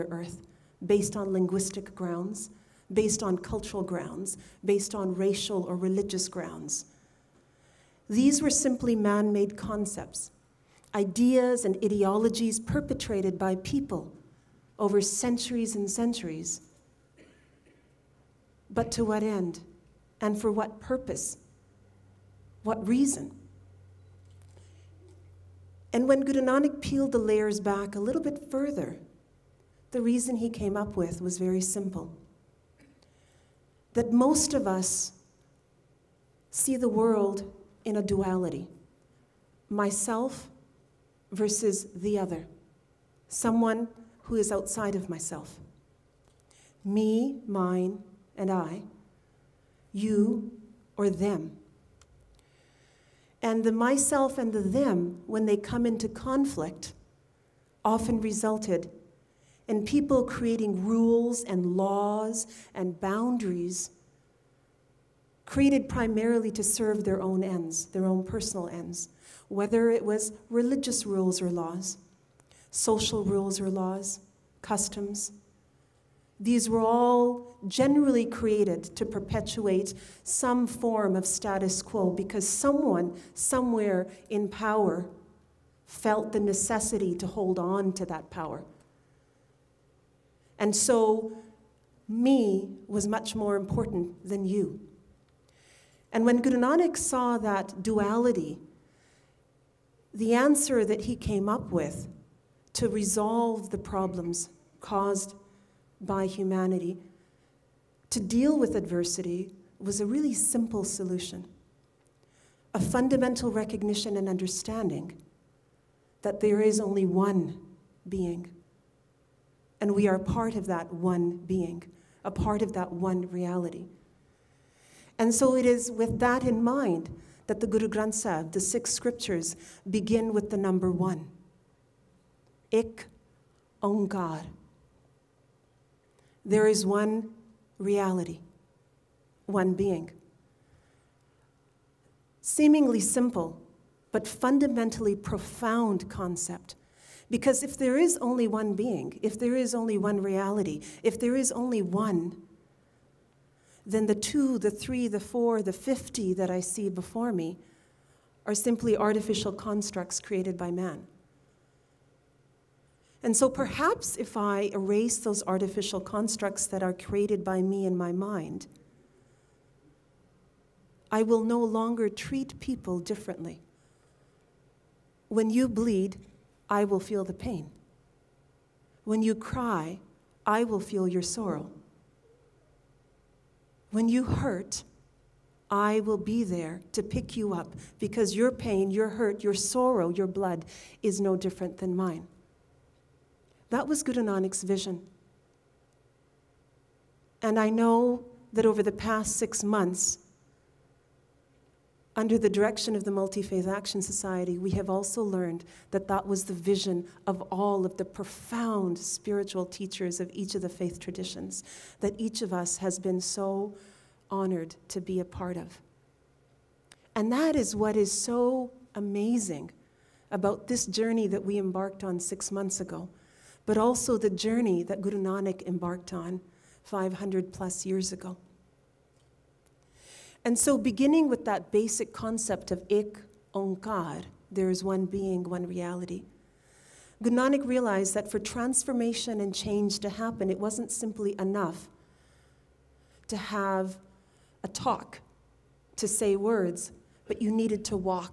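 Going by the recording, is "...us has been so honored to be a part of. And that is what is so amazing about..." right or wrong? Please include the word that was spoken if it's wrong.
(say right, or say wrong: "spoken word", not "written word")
right.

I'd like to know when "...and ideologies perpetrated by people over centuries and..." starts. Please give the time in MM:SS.
00:11.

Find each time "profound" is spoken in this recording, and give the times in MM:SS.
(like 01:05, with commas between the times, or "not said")
02:25, 03:28.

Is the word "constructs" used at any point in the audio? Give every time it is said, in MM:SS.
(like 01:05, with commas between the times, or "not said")
02:39, 02:45.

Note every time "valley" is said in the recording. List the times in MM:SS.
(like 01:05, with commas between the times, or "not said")
not said.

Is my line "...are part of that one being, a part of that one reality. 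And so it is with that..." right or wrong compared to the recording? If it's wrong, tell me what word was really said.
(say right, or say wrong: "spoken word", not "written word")
right.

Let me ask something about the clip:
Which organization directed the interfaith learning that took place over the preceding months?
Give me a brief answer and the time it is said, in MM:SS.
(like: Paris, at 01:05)
Multi Faith Action Society, at 03:23.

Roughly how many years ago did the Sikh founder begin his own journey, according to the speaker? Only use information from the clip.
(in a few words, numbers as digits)
500 plus years.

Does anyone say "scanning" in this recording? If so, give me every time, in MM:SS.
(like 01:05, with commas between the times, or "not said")
not said.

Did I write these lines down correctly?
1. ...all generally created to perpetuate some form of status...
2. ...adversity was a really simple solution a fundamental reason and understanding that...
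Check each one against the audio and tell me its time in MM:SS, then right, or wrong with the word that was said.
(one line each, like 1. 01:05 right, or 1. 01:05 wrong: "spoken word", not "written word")
1. 01:16 right
2. 01:48 wrong: "recognition", not "reason".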